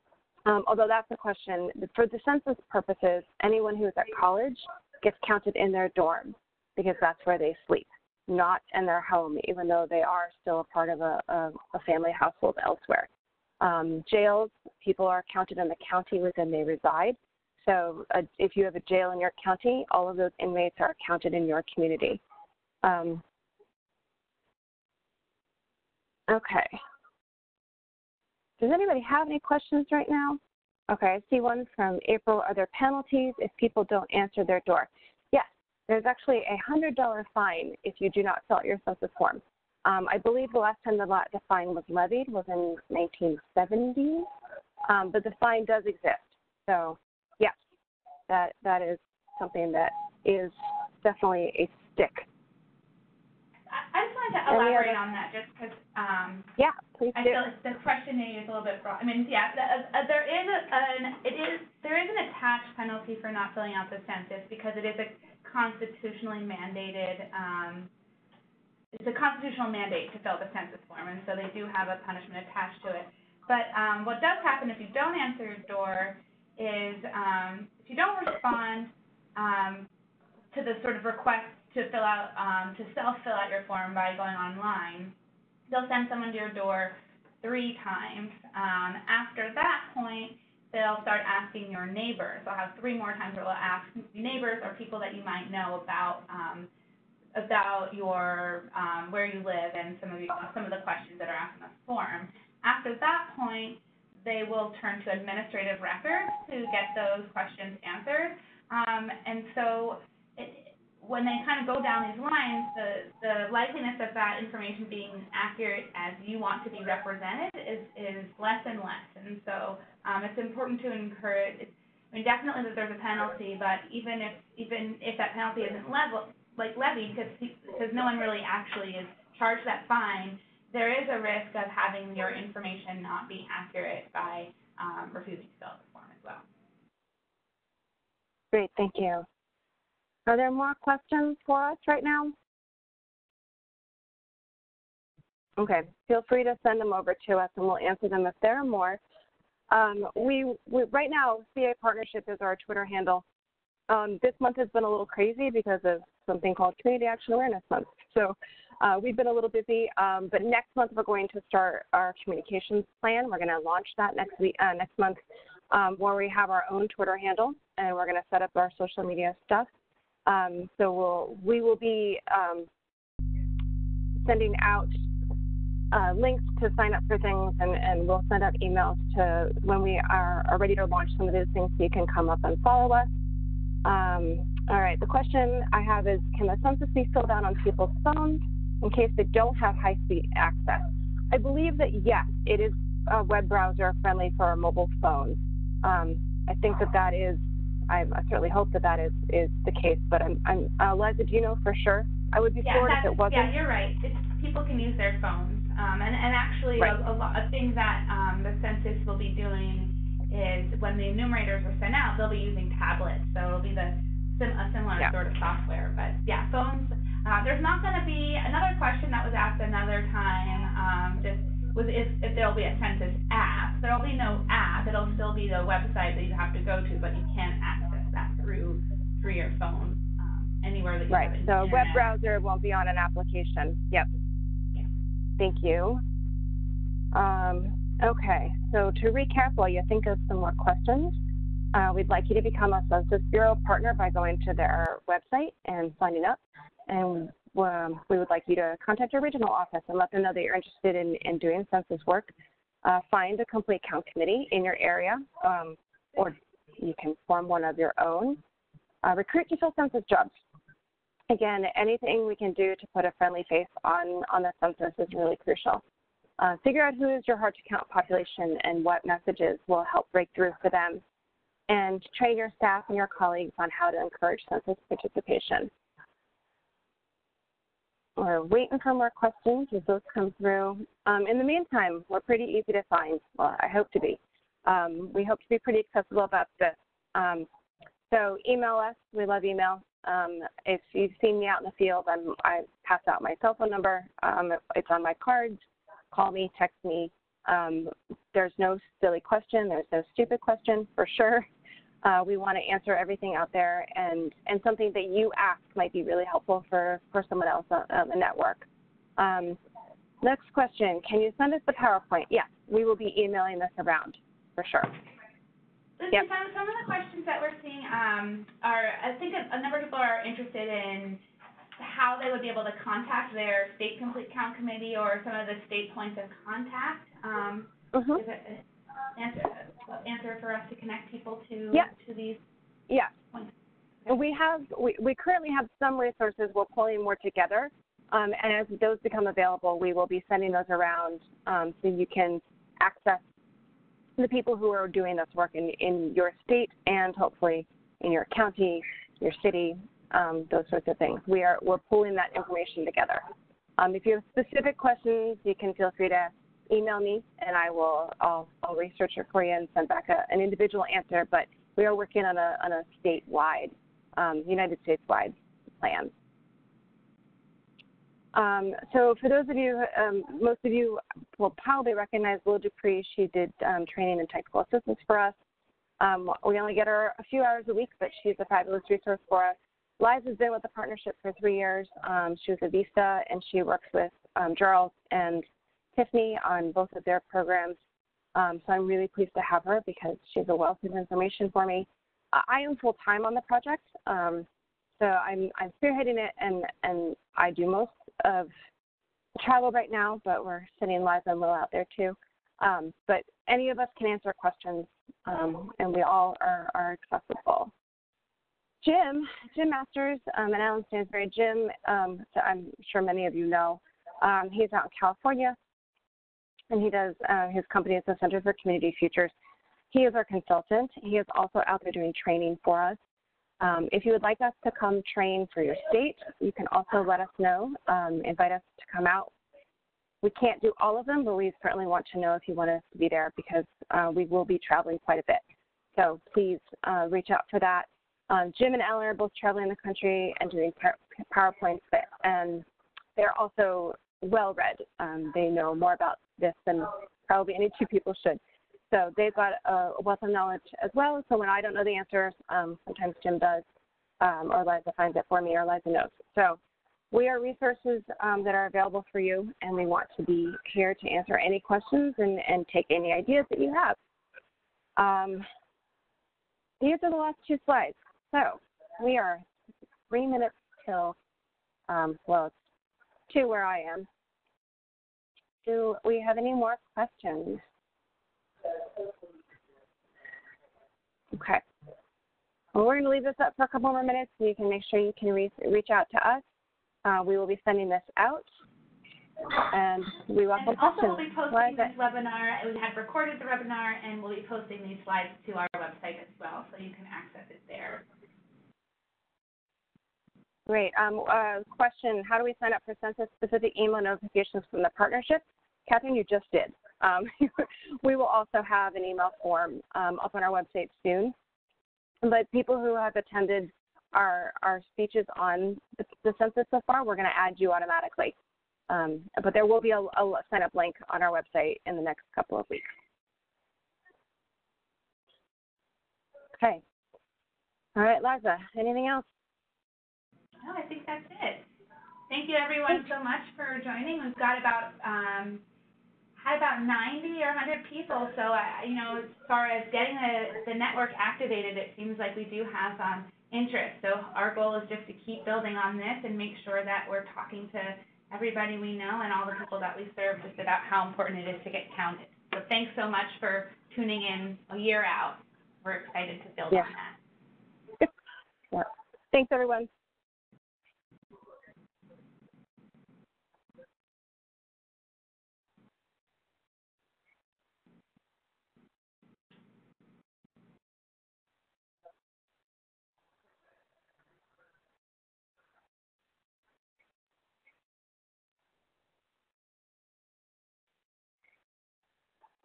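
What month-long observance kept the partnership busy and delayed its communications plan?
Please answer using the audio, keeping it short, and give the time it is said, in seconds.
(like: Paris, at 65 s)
Community Action Awareness Month, at 156 s.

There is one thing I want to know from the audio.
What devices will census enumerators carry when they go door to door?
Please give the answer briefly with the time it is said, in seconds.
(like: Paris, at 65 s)
tablets, at 212 s.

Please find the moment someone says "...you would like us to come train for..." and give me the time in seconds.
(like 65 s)
424 s.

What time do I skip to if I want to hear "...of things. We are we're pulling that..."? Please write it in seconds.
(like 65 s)
350 s.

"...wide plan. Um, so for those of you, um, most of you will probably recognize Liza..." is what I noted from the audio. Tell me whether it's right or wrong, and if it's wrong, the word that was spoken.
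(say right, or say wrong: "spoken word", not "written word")
wrong: "Will", not "Liza".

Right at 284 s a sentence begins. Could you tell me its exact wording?
Um, we hope to be pretty accessible about this.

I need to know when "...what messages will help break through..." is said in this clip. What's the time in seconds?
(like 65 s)
268 s.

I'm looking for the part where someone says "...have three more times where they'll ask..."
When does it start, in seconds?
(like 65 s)
92 s.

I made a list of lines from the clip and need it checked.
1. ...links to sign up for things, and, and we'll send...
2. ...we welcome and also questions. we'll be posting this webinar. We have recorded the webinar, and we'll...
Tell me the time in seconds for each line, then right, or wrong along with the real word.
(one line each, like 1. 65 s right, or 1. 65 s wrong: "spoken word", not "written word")
1. 176 s right
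2. 490 s right.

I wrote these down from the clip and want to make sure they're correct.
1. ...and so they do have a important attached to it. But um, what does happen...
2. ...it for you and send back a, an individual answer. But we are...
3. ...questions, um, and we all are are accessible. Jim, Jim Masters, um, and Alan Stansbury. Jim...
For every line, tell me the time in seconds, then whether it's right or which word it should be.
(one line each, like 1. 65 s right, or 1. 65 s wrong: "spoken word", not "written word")
1. 71 s wrong: "punishment", not "important"
2. 359 s right
3. 404 s right.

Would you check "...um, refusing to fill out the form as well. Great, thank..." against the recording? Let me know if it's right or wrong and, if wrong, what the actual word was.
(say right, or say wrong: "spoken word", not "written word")
right.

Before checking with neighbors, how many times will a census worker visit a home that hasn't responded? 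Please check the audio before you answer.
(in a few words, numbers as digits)
3.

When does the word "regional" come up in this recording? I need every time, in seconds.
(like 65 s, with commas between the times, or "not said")
249 s.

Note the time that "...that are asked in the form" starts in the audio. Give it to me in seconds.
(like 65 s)
101 s.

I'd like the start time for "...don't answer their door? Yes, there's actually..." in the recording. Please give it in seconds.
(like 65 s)
33 s.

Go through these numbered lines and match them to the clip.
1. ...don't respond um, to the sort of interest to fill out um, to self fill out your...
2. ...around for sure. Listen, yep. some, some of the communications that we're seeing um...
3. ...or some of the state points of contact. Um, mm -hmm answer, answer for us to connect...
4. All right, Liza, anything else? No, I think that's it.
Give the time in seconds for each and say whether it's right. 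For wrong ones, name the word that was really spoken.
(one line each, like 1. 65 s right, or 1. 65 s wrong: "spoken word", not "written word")
1. 77 s wrong: "request", not "interest"
2. 313 s wrong: "questions", not "communications"
3. 324 s right
4. 527 s right.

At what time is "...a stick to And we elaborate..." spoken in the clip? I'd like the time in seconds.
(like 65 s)
51 s.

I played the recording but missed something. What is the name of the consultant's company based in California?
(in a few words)
Center for Community Futures.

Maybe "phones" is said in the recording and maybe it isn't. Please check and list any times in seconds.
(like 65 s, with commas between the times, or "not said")
188 s, 194 s, 205 s, 216 s, 229 s, 293 s.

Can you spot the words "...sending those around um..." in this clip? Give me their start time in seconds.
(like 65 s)
340 s.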